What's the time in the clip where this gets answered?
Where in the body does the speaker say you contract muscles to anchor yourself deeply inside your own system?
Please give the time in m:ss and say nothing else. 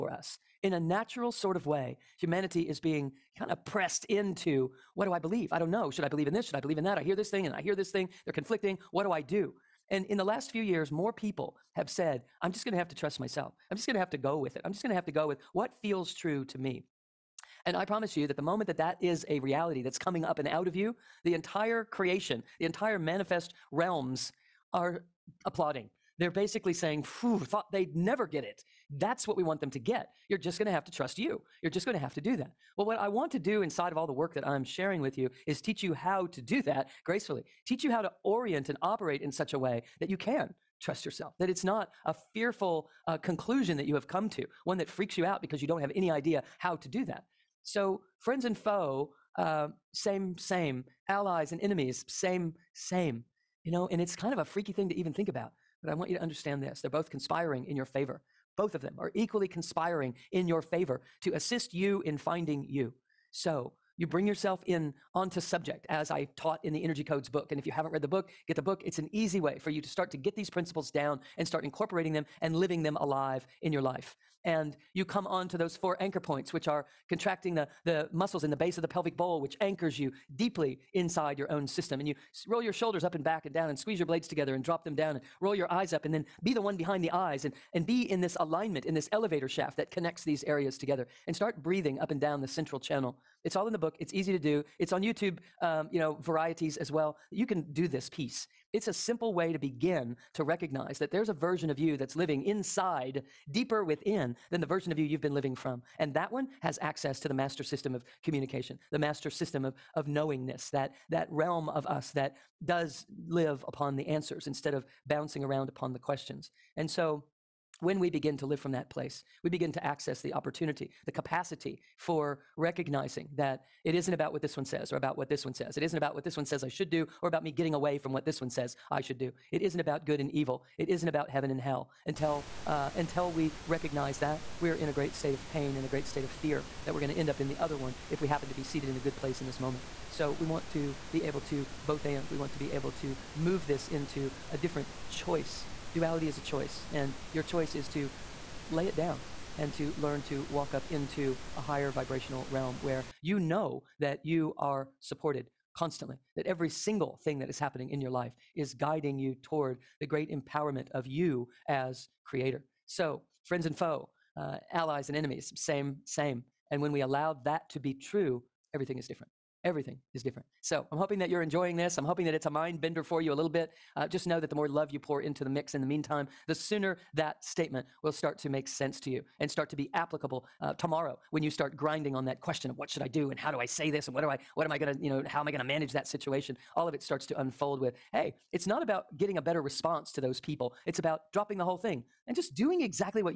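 1:18.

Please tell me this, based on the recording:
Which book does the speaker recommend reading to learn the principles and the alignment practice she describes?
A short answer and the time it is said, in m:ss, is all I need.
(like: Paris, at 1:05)
The Energy Codes, at 1:06.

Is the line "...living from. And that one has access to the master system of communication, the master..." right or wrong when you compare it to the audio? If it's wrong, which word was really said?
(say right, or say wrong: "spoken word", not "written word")
right.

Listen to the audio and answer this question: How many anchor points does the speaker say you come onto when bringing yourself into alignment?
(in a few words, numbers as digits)
4.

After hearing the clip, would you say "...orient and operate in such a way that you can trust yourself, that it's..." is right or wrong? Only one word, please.
right.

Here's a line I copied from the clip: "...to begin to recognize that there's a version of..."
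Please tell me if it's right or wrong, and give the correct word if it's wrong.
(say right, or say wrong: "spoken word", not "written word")
right.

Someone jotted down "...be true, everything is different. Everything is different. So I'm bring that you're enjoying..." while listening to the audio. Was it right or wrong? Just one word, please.
wrong.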